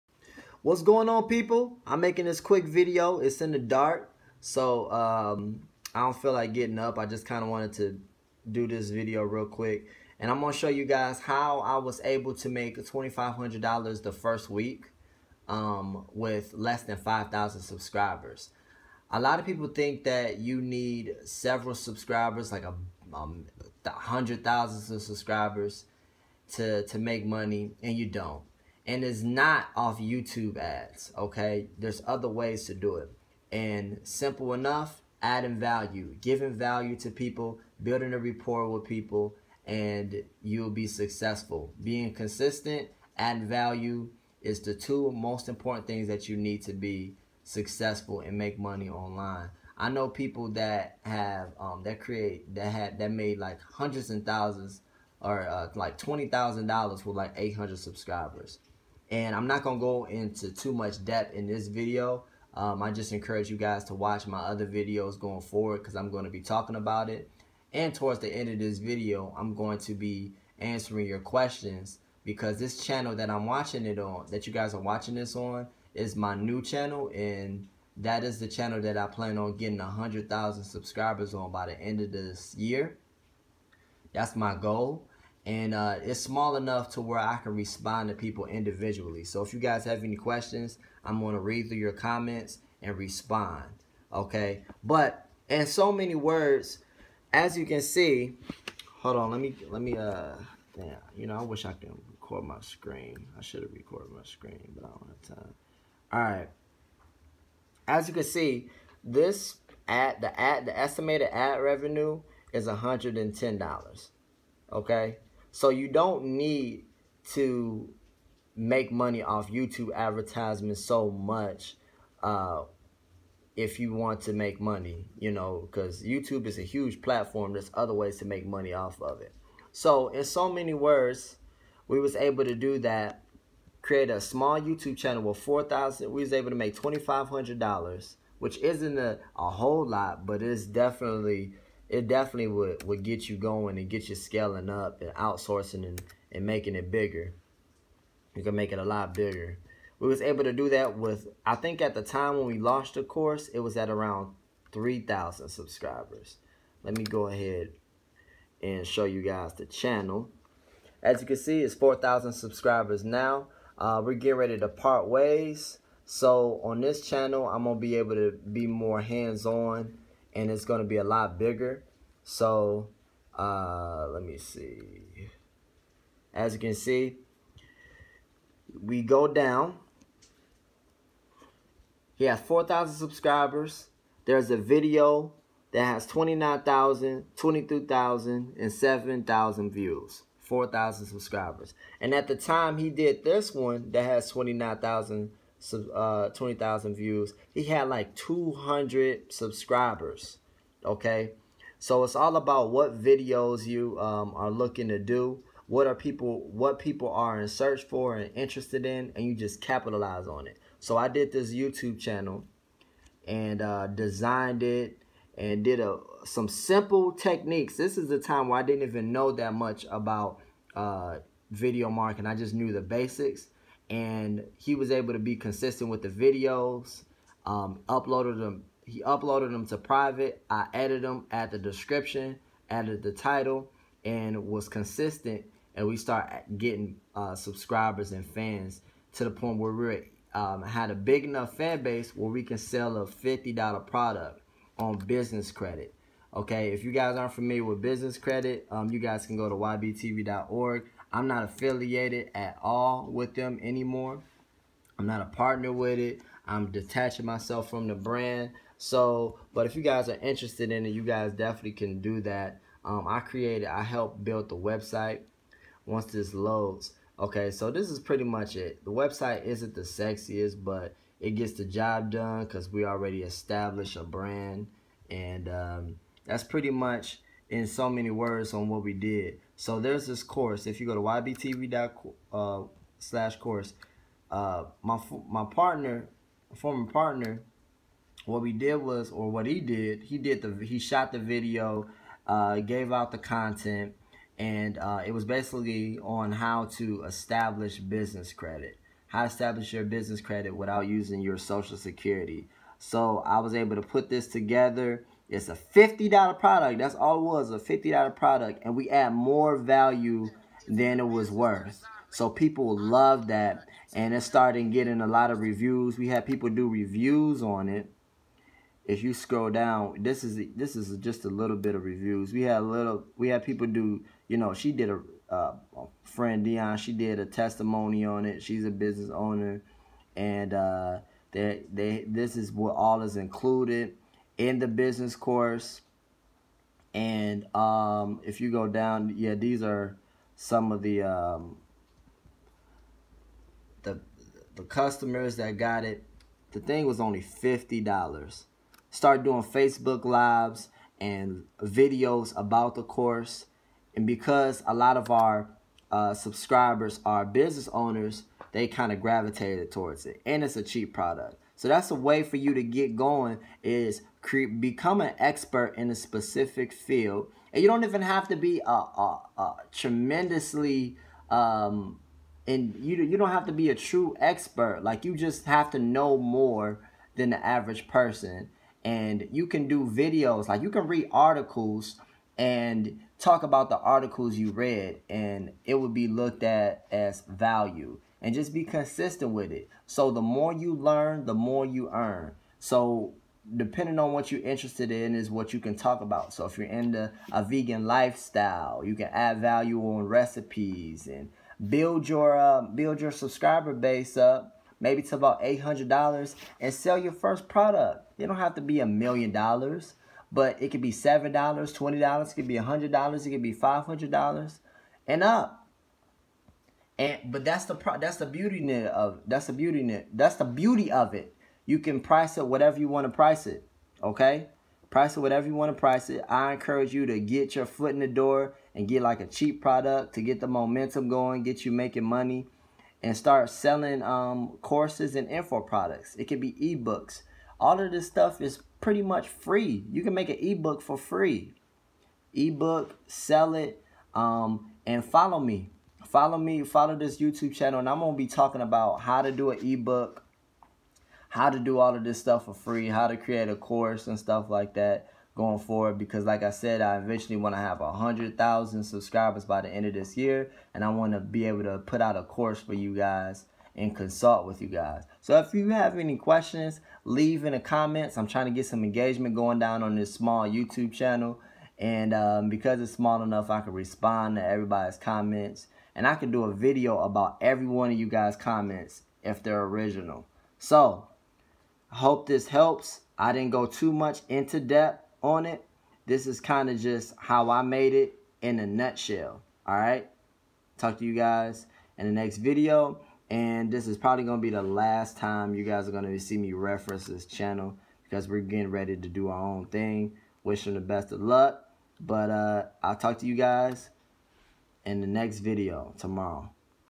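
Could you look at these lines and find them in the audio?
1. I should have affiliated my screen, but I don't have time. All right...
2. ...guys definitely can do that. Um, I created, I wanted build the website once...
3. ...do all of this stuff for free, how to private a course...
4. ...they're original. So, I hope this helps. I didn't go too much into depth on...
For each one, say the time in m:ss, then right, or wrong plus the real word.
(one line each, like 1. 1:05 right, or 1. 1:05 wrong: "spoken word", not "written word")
1. 1:43 wrong: "recorded", not "affiliated"
2. 4:21 wrong: "helped", not "wanted"
3. 7:31 wrong: "create", not "private"
4. 7:59 right.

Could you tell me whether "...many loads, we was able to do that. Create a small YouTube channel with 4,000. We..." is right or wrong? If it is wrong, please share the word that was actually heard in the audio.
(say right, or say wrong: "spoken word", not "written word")
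wrong: "words", not "loads".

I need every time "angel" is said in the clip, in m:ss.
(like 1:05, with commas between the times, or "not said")
not said.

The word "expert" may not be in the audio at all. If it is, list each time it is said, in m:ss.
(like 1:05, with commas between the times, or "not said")
6:05, 6:14.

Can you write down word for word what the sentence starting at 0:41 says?
Being consistent, adding value is the two most important things that you need to be successful and make money online.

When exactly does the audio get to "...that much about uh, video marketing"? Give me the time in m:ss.
3:39.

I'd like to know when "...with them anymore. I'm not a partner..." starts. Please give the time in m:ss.
4:13.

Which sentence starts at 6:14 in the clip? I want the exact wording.
Like you just have to know more than the average person.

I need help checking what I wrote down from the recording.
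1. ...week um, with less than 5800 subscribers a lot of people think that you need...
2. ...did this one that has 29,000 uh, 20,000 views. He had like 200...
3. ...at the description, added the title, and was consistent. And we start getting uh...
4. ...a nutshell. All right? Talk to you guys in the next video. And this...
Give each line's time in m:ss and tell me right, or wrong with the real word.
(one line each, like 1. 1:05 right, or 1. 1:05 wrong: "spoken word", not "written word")
1. 0:14 wrong: "5000", not "5800"
2. 3:12 right
3. 3:51 right
4. 8:08 right.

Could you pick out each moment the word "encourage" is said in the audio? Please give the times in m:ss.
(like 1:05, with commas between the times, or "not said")
1:03, 7:06.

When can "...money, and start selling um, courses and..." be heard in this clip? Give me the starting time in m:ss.
7:12.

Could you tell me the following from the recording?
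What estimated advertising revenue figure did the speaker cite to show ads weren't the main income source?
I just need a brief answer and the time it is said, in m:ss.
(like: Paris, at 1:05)
$110, at 1:52.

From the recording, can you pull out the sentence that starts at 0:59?
And I'm not going to go into too much depth in this video.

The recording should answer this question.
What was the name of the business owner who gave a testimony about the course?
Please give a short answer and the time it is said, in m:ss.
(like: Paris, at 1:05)
Dion, at 5:26.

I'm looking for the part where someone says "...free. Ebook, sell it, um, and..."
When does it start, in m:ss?
7:20.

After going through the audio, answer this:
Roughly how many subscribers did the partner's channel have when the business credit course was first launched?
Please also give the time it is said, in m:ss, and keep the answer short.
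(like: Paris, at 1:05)
3,000, at 2:34.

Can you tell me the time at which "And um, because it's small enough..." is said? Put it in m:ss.
7:51.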